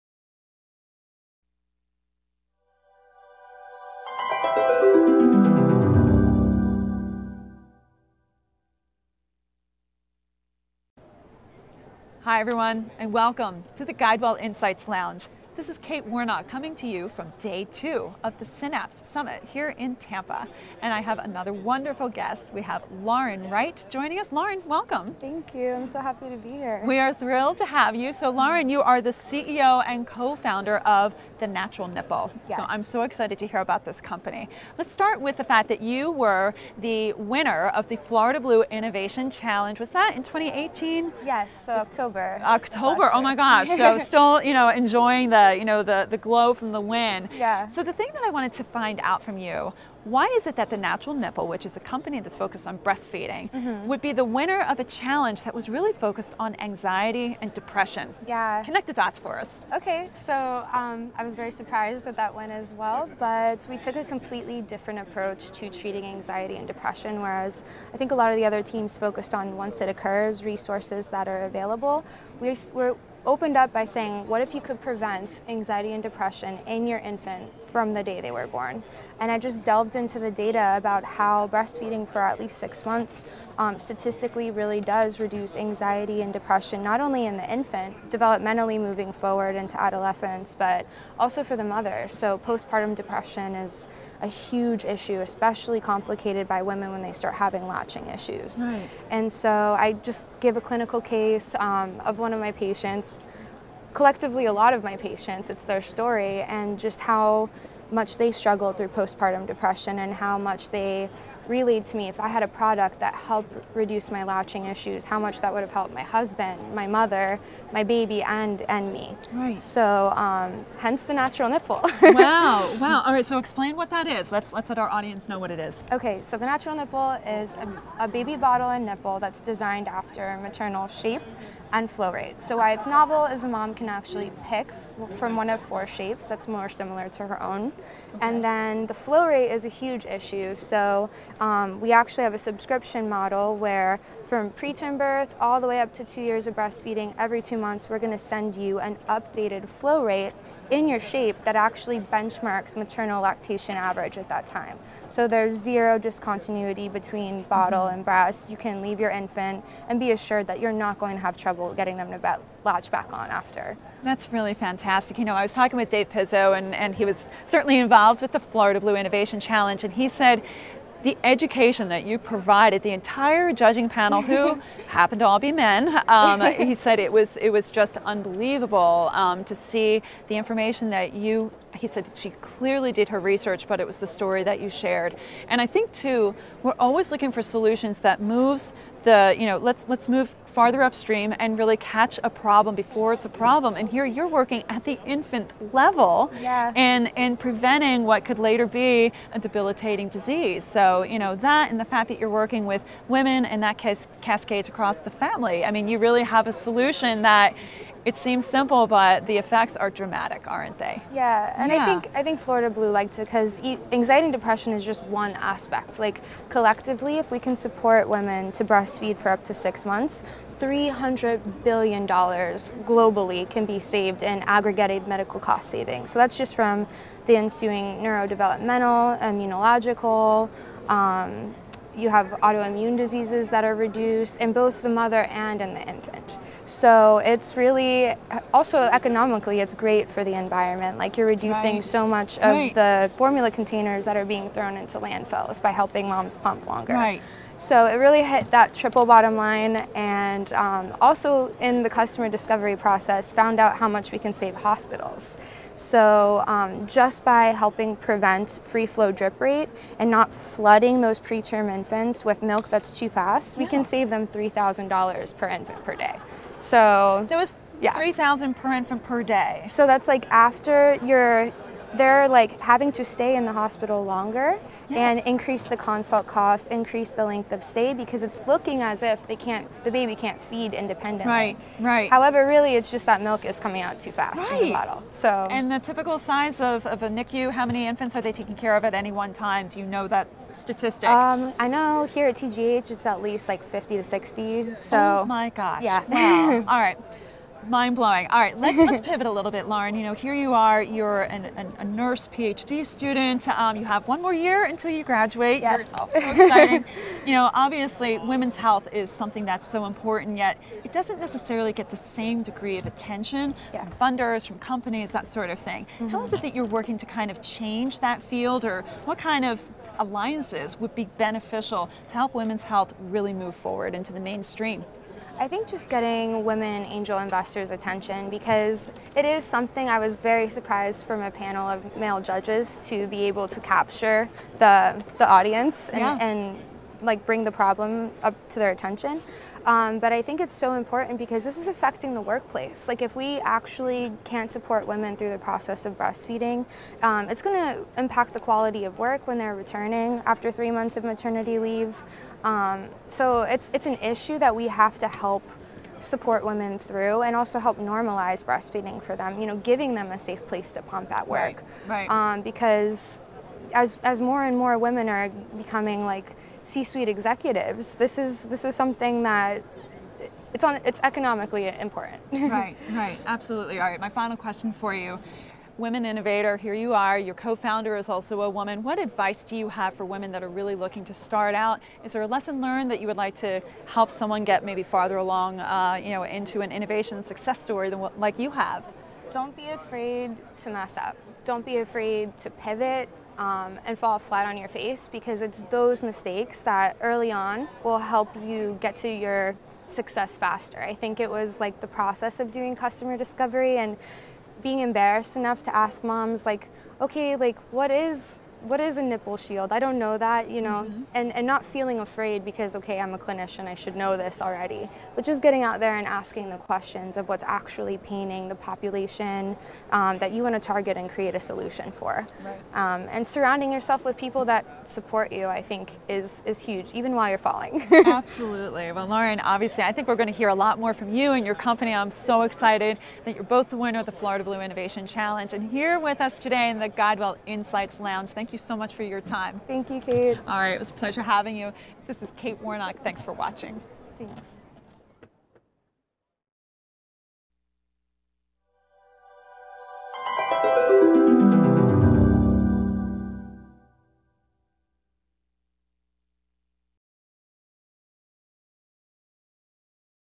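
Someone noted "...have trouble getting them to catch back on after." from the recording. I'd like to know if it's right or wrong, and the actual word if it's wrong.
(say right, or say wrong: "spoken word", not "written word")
wrong: "latch", not "catch".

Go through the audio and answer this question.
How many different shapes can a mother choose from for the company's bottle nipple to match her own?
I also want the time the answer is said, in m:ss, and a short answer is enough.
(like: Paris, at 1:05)
4, at 2:15.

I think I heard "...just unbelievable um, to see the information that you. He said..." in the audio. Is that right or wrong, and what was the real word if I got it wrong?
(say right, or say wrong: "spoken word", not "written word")
right.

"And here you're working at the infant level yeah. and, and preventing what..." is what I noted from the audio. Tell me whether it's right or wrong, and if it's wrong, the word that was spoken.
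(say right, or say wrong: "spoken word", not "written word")
right.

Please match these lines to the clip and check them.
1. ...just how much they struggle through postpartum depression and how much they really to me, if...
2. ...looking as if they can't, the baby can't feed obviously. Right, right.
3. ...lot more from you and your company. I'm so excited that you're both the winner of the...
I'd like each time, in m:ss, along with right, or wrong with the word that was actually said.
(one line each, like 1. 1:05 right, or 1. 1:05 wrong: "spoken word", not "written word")
1. 1:46 right
2. 4:38 wrong: "independently", not "obviously"
3. 7:10 right.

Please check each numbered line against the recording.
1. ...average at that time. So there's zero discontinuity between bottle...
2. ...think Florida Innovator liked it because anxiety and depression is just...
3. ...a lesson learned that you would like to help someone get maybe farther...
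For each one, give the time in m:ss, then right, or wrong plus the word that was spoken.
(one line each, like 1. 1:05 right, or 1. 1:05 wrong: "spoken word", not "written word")
1. 2:33 right
2. 3:32 wrong: "Blue", not "Innovator"
3. 6:22 right.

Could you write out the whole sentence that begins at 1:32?
So postpartum depression is a huge issue, especially complicated by women when they start having latching issues.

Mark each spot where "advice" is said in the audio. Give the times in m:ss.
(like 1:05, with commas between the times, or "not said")
6:18.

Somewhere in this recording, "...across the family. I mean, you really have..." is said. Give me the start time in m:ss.
3:24.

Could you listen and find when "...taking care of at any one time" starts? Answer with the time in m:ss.
4:48.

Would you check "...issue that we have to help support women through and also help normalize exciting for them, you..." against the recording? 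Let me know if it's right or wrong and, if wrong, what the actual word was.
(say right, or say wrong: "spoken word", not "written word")
wrong: "breastfeeding", not "exciting".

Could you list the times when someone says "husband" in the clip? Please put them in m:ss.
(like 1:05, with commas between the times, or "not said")
1:56.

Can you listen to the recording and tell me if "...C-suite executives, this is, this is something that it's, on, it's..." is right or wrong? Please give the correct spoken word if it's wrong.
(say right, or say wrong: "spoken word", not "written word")
right.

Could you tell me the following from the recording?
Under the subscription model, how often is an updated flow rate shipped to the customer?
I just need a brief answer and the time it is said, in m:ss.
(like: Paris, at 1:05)
every two months, at 2:27.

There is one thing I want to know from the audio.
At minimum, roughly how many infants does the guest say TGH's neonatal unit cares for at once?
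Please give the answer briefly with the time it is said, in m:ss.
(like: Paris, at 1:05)
50 to 60, at 4:53.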